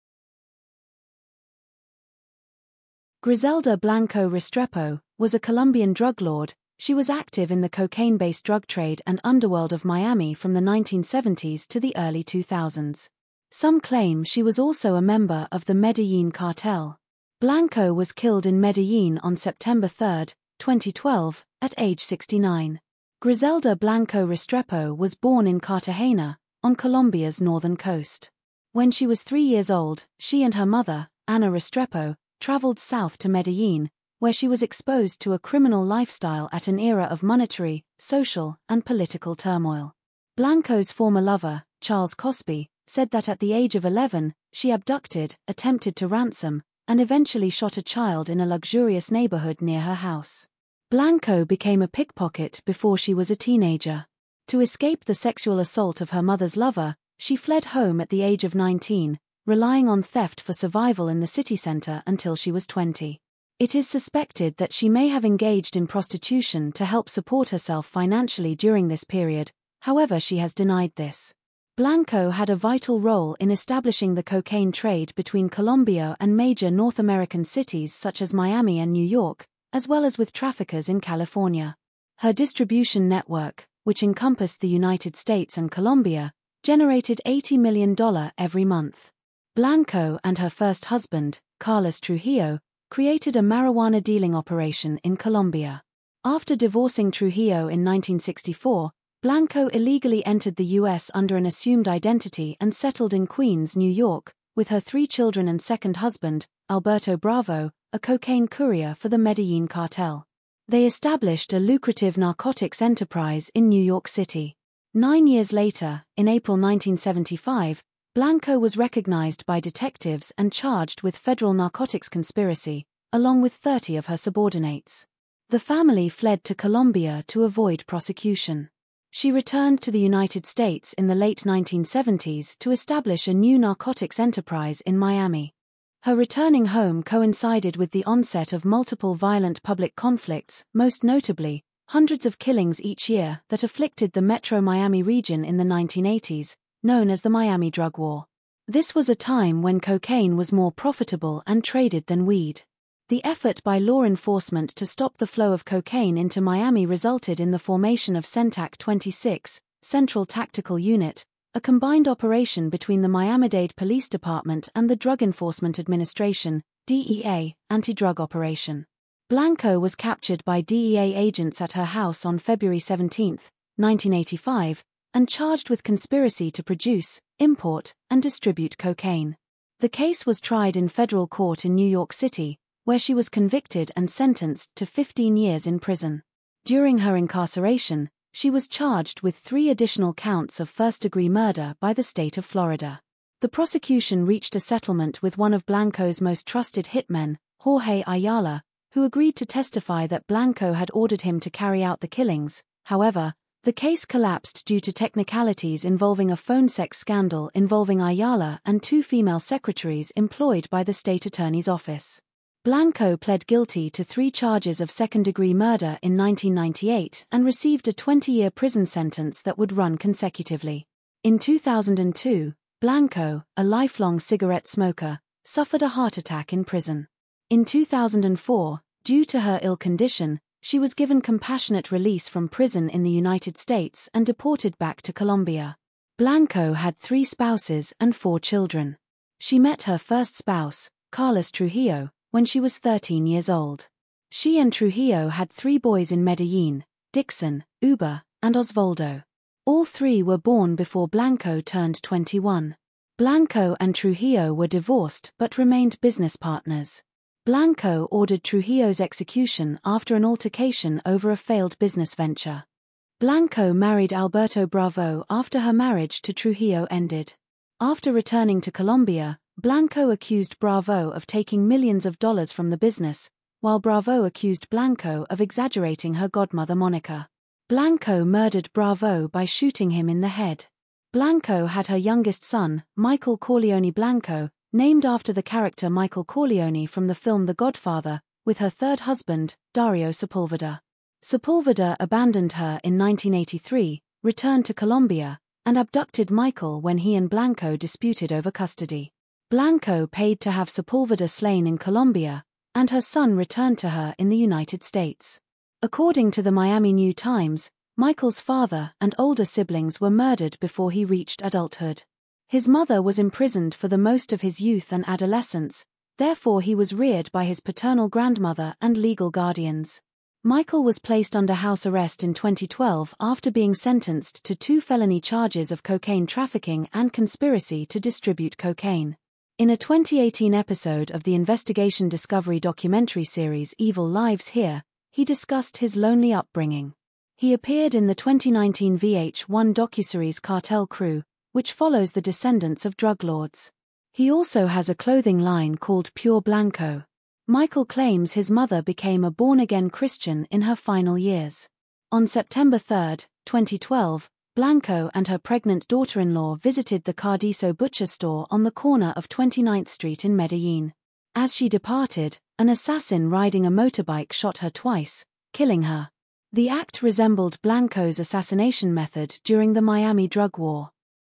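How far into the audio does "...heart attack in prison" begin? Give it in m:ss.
3:45.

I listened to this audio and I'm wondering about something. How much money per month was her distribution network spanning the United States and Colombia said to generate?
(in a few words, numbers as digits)
$80 million.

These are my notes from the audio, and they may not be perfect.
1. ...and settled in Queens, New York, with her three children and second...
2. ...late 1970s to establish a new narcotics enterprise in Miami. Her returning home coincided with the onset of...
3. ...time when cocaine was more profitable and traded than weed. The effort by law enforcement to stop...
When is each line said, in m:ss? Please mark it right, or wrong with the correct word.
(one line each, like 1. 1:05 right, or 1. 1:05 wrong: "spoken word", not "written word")
1. 1:42 right
2. 2:11 right
3. 2:29 right.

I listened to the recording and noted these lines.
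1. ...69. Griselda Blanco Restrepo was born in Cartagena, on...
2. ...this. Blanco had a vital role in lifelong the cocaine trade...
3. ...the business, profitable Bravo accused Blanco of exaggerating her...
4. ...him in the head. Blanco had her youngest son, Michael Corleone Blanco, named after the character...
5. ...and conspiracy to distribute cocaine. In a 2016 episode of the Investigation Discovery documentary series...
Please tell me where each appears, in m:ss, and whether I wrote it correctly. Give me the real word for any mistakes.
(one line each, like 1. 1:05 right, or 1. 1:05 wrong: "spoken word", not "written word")
1. 0:22 right
2. 1:10 wrong: "establishing", not "lifelong"
3. 4:32 wrong: "while", not "profitable"
4. 4:39 right
5. 5:26 wrong: "2018", not "2016".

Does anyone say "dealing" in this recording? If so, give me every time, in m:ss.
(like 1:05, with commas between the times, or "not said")
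1:34.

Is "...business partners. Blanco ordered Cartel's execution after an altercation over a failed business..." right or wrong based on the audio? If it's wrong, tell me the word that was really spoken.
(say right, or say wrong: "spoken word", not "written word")
wrong: "Trujillo", not "Cartel".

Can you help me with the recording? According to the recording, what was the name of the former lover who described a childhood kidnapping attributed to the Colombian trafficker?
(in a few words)
Charles Cosby.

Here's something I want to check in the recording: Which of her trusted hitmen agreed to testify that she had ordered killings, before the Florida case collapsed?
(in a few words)
Jorge Ayala.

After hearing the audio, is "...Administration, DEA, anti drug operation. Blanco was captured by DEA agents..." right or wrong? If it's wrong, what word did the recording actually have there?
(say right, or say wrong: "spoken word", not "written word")
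right.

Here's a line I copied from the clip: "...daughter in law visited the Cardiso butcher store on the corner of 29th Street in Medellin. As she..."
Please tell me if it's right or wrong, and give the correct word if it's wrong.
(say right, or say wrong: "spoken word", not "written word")
right.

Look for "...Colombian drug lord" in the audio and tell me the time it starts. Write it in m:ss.
0:05.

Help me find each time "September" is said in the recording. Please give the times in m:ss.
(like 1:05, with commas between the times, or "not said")
0:19, 5:52.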